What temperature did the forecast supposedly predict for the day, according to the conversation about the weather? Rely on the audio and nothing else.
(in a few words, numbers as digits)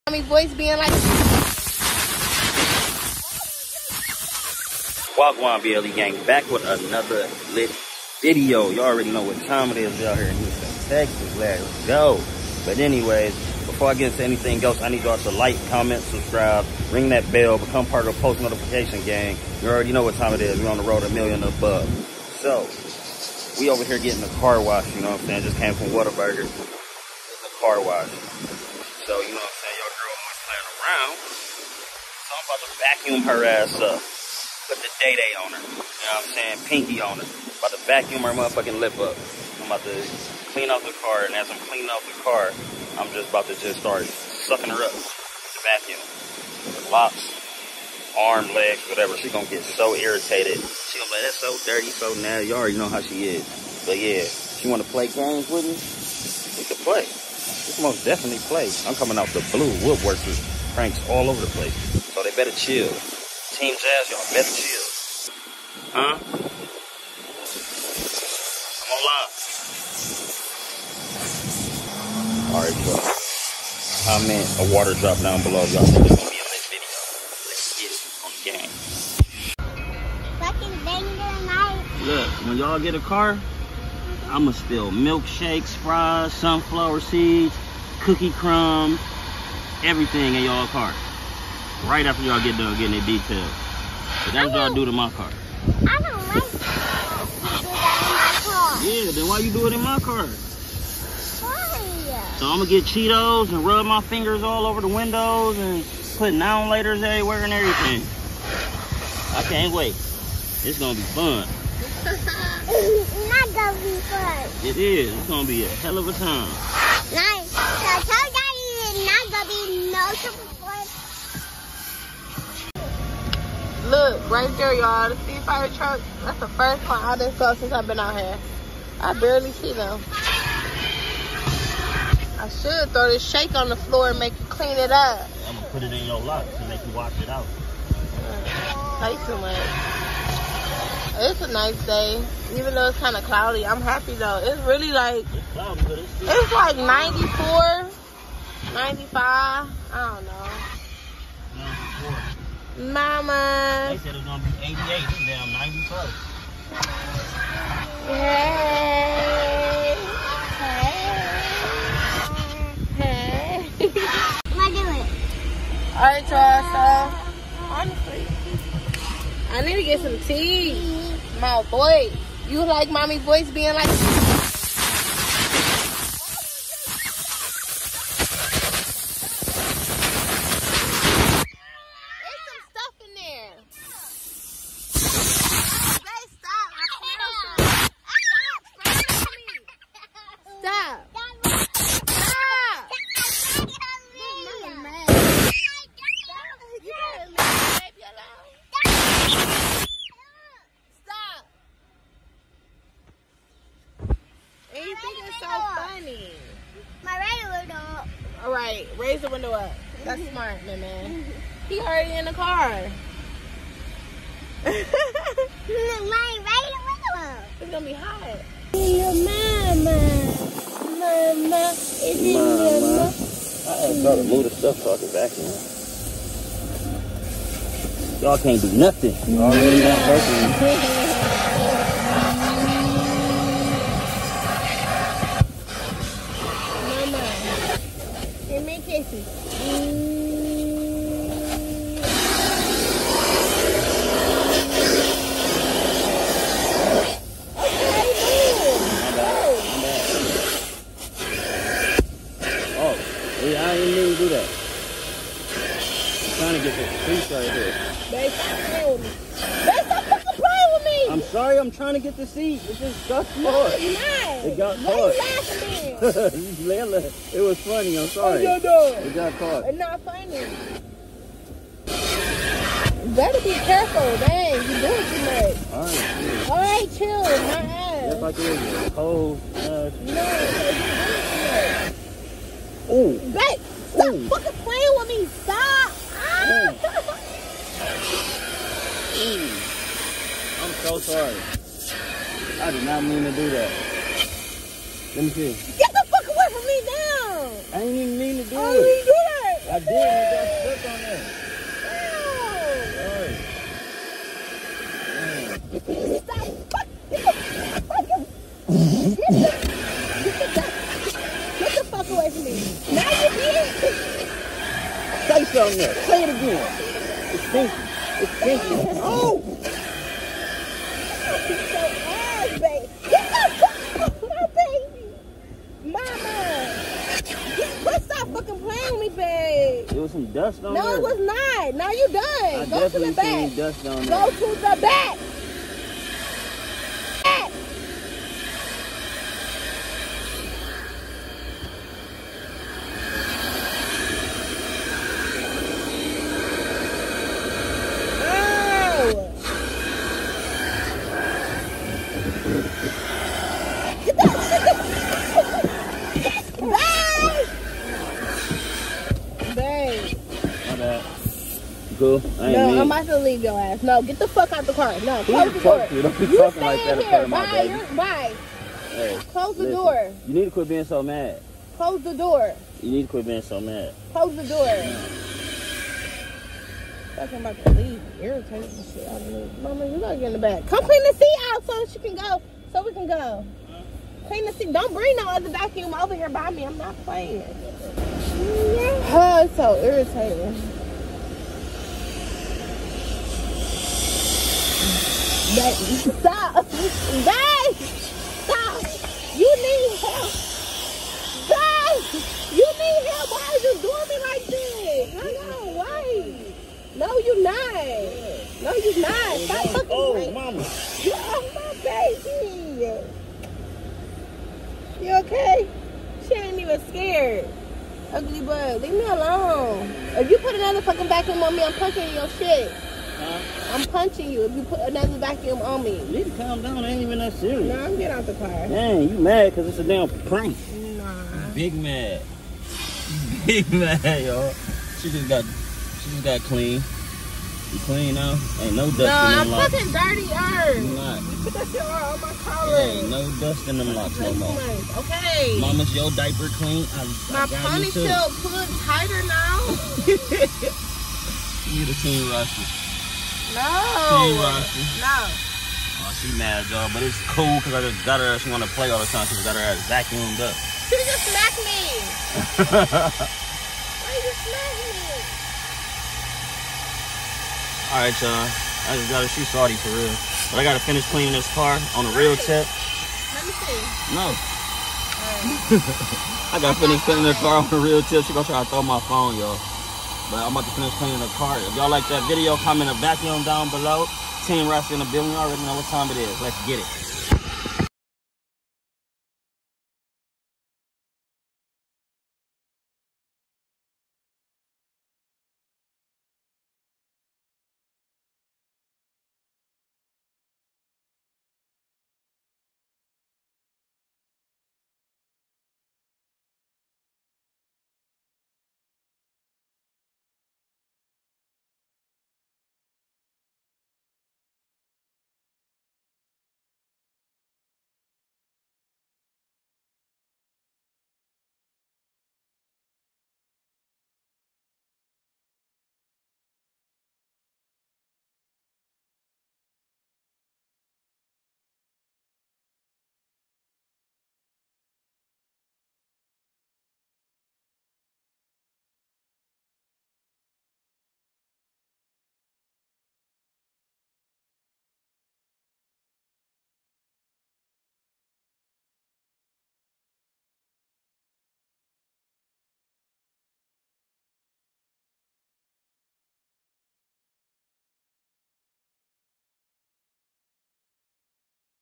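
88.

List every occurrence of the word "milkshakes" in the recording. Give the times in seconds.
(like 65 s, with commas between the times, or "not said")
84 s.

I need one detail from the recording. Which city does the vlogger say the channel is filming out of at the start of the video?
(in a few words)
Houston, Texas.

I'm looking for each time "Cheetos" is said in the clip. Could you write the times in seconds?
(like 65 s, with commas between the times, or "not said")
102 s.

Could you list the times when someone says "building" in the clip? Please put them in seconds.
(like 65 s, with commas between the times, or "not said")
485 s.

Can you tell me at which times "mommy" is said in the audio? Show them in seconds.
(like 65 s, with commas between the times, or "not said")
0 s, 172 s.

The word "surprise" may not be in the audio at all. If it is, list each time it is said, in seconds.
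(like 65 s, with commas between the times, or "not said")
120 s.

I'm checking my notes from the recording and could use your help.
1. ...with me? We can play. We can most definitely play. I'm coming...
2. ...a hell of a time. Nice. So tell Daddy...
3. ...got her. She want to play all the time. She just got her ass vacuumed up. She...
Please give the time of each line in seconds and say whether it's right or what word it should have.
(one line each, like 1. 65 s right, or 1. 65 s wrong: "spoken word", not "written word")
1. 55 s right
2. 115 s right
3. 458 s right.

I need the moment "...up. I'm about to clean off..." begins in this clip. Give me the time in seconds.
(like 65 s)
38 s.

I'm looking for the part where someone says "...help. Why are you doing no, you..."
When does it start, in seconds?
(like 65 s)
403 s.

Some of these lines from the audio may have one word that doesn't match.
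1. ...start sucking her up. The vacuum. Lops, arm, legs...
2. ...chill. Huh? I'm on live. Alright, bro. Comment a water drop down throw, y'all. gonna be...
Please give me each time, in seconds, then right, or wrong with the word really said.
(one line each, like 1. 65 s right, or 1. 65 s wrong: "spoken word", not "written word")
1. 43 s right
2. 64 s wrong: "below", not "throw".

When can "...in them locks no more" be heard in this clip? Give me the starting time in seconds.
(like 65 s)
443 s.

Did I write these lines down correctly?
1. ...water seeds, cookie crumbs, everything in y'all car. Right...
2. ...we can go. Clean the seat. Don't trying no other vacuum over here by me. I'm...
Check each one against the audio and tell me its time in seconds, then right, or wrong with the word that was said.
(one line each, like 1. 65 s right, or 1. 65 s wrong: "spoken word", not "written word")
1. 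86 s wrong: "sunflower", not "water"
2. 382 s wrong: "bring", not "trying".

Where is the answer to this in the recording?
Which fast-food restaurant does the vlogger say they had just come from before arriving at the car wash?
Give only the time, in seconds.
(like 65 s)
25 s.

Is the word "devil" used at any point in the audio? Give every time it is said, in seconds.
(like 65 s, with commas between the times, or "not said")
not said.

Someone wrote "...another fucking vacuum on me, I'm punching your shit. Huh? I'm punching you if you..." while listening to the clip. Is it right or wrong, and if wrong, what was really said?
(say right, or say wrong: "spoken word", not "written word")
right.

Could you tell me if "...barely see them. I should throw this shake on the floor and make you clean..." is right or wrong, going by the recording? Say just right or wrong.
right.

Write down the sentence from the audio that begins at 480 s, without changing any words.
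But I'm about to finish cleaning the car.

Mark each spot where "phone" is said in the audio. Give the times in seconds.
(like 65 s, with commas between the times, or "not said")
479 s.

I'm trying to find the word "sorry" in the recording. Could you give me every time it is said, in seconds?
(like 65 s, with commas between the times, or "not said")
261 s, 268 s, 291 s.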